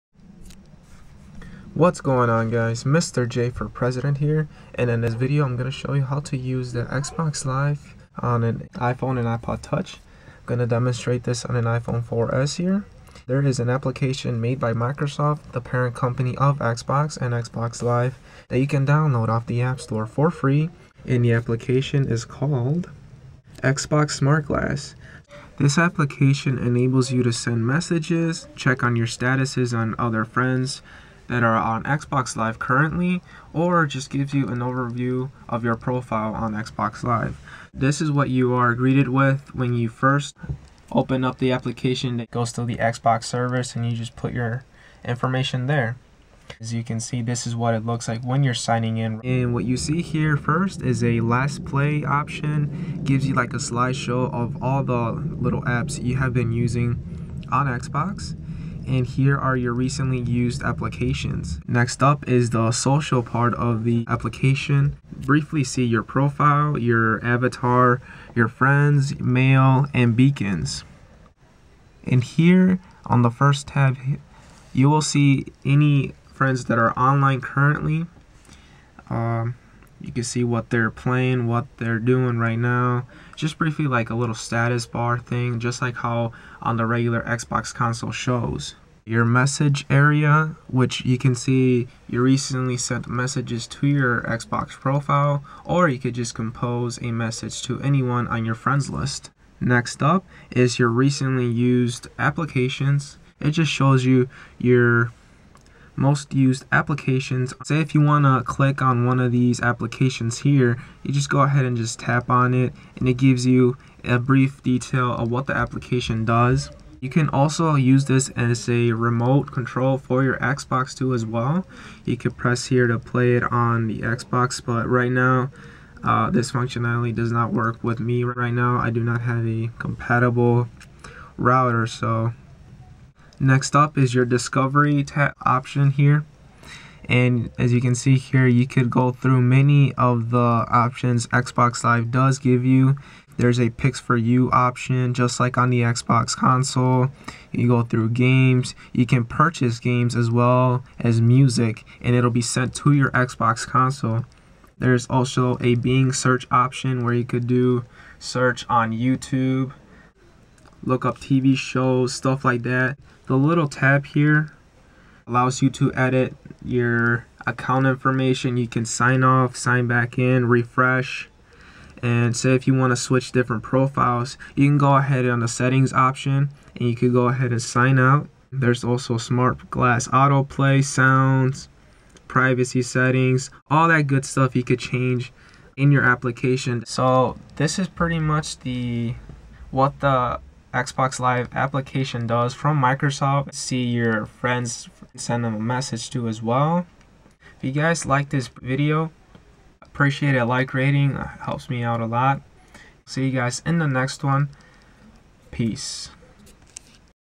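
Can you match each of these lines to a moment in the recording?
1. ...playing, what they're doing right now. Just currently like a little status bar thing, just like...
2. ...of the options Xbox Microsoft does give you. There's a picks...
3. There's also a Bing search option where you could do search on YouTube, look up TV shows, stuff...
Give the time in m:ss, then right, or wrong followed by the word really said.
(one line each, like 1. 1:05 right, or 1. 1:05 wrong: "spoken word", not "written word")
1. 1:20 wrong: "briefly", not "currently"
2. 2:19 wrong: "Live", not "Microsoft"
3. 2:34 right.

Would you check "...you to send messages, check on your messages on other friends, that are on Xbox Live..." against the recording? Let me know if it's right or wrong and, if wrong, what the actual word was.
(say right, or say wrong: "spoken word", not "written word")
wrong: "statuses", not "messages".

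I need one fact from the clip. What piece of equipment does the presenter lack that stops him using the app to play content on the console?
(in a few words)
compatible router.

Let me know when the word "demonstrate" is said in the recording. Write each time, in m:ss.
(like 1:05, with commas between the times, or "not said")
0:10.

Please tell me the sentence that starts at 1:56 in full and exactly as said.
You can also use this as a remote control for your Xbox 2 as well.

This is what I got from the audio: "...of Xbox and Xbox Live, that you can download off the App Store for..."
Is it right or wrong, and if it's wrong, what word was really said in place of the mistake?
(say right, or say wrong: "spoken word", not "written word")
right.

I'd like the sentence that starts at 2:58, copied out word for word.
There's also smart glass autoplay, sounds, privacy settings, all that good stuff you could change in your application.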